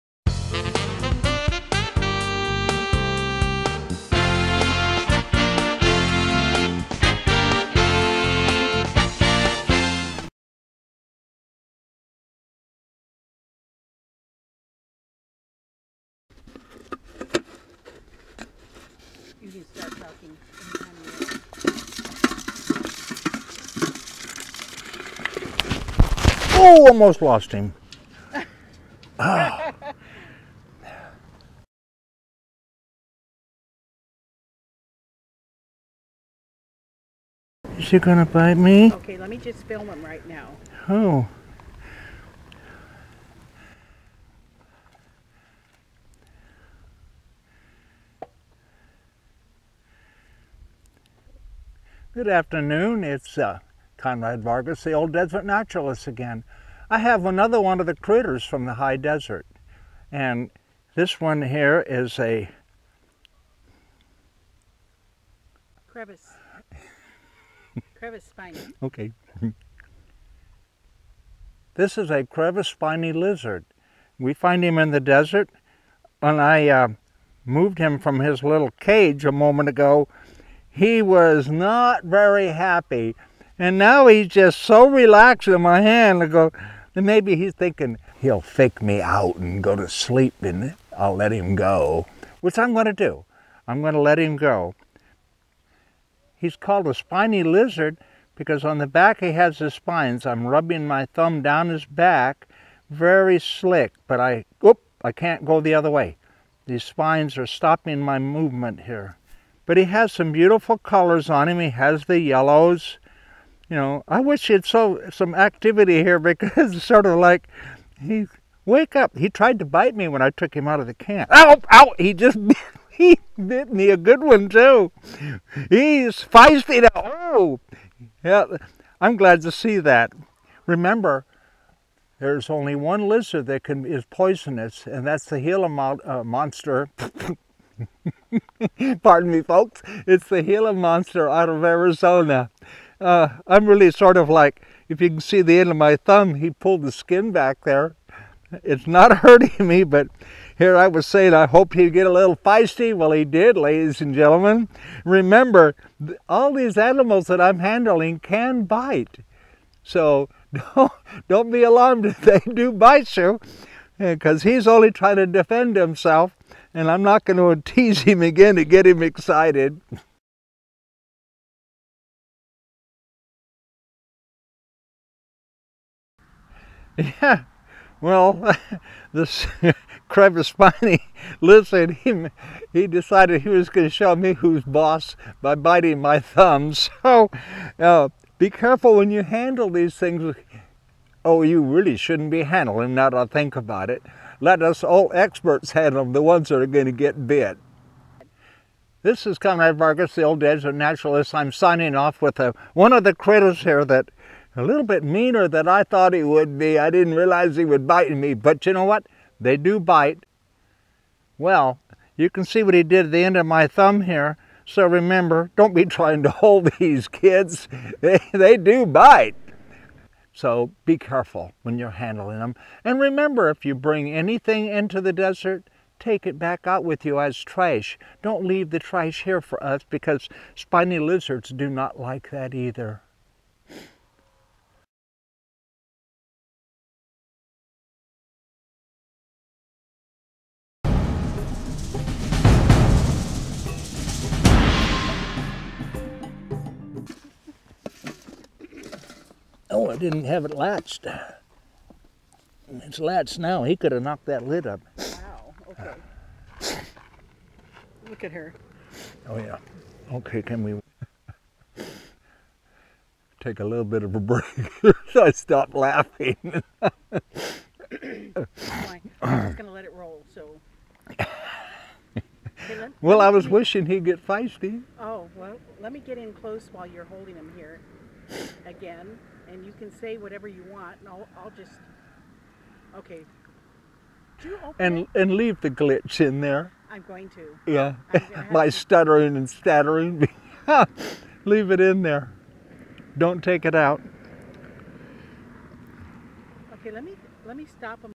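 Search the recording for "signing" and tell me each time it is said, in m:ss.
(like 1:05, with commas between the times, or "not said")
3:21.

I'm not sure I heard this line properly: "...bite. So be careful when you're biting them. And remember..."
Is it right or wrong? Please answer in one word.
wrong.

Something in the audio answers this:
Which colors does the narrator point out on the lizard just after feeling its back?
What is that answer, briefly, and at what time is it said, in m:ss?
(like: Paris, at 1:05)
Yellows, at 1:52.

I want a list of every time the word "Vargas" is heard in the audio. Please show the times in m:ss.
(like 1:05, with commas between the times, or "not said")
0:54, 3:19.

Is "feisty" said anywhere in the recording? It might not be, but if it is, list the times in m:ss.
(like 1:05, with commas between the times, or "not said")
2:06, 2:32, 4:34.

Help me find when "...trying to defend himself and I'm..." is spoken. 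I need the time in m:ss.
2:44.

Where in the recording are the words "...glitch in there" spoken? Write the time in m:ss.
4:45.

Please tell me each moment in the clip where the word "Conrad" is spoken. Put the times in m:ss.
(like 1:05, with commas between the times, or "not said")
0:53, 3:19.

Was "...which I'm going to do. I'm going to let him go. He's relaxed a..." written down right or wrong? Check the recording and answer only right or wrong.
wrong.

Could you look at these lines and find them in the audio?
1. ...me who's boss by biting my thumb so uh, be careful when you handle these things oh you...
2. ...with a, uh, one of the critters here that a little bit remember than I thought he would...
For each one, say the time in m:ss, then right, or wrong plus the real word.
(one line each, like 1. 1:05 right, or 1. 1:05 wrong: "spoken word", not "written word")
1. 3:04 right
2. 3:22 wrong: "meaner", not "remember".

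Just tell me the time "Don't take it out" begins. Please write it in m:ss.
4:53.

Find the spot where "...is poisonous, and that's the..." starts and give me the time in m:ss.
2:13.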